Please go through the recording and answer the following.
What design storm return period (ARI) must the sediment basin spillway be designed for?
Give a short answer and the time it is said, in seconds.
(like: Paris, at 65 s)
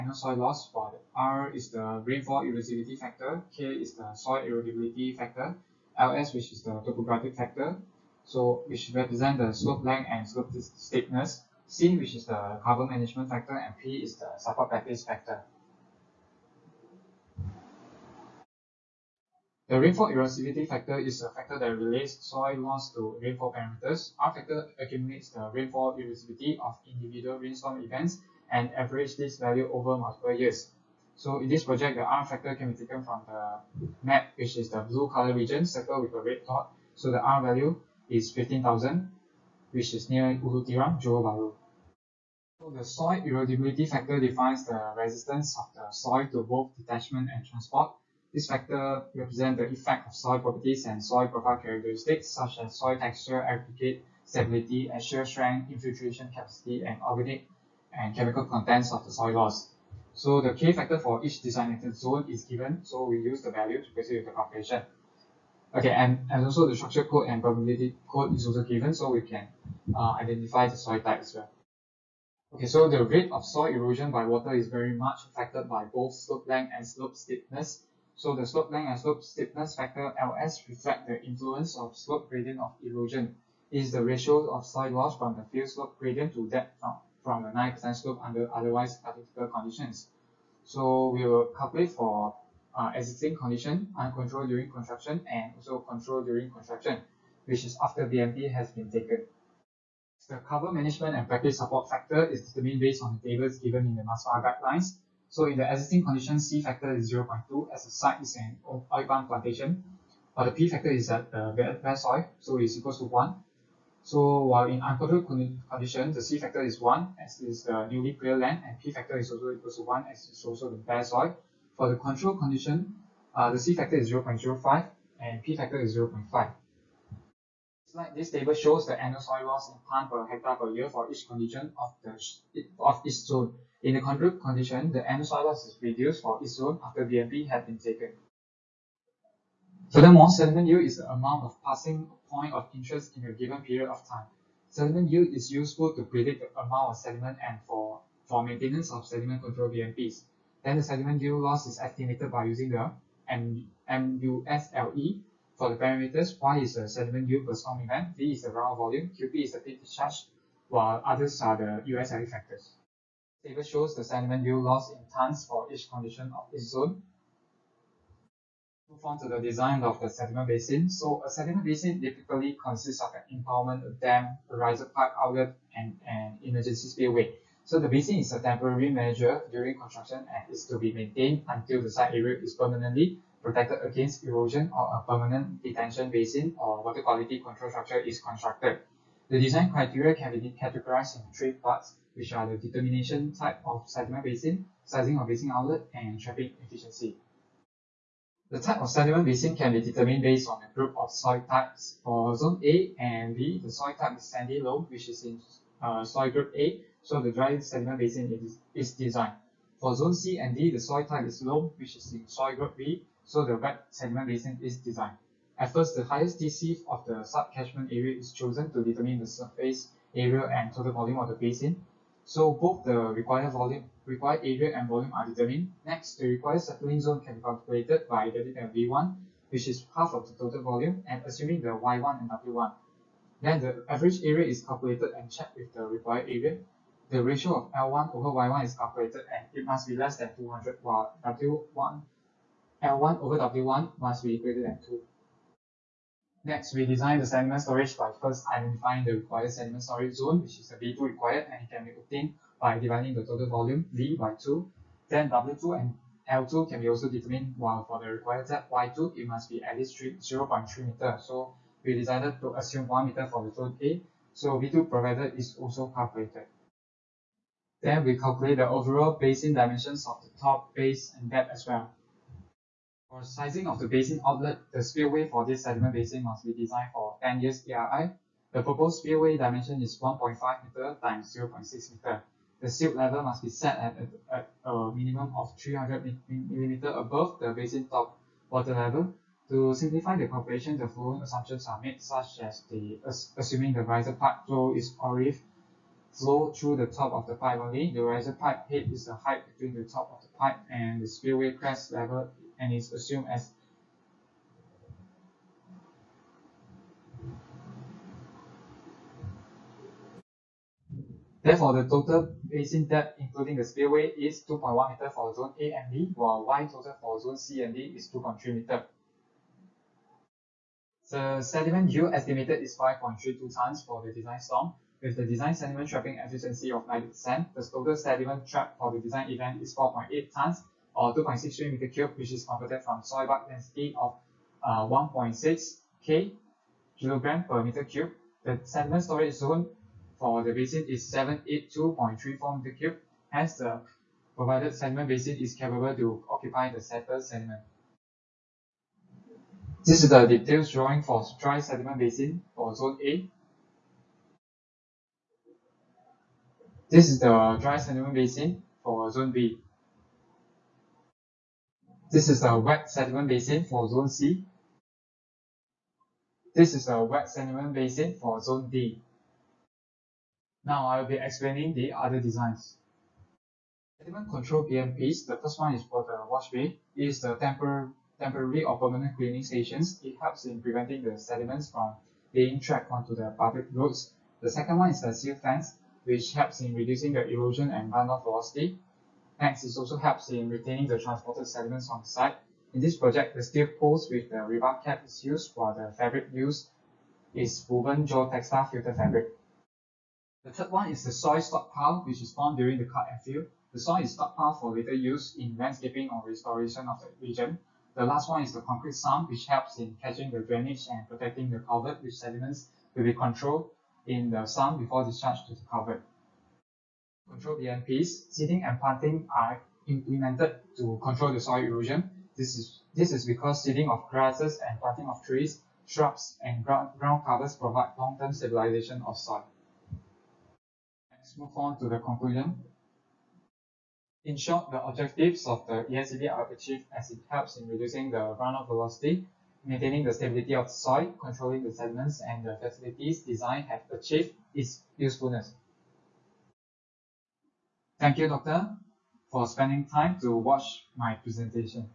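10 years, at 277 s.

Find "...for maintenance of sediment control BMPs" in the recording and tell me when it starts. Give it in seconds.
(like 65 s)
148 s.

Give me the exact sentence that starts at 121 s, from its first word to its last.
For the control condition, uh, the C factor is 0.05 and P factor is 0.5.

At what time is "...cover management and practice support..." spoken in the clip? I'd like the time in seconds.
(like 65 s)
100 s.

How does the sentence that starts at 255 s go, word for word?
Then W2 and L2 can be also determined, while for the required depth Y2, it must be at least 0.3 meter.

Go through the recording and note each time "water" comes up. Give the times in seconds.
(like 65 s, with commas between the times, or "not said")
74 s, 186 s, 288 s.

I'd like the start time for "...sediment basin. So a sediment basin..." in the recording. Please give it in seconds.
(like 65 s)
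170 s.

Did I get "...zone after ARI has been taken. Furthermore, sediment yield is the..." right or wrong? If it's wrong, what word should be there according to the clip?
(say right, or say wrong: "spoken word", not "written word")
wrong: "BMP", not "ARI".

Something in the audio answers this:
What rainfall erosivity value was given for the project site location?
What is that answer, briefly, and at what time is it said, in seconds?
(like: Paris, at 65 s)
15,000, at 38 s.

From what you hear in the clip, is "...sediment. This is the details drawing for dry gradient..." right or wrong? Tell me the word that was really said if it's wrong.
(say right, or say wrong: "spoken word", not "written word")
wrong: "sediment", not "gradient".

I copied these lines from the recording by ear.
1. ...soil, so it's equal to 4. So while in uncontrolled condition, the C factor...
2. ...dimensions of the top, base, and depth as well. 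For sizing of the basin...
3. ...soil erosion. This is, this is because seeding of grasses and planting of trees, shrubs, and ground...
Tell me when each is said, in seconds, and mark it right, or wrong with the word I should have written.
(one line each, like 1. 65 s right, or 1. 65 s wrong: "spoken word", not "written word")
1. 111 s wrong: "1", not "4"
2. 269 s right
3. 421 s right.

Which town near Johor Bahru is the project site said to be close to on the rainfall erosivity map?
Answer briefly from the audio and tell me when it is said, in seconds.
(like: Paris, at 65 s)
Ulu Tiram, at 40 s.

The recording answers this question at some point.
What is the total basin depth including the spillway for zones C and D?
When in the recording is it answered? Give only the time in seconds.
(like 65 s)
318 s.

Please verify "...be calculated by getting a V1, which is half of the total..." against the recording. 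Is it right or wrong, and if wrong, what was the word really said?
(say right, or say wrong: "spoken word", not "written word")
right.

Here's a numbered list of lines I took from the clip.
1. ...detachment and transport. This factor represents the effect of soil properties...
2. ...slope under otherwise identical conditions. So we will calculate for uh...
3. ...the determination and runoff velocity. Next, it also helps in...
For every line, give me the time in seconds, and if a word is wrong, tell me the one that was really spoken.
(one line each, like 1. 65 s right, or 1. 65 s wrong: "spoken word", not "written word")
1. 46 s right
2. 87 s right
3. 387 s wrong: "erosion", not "determination".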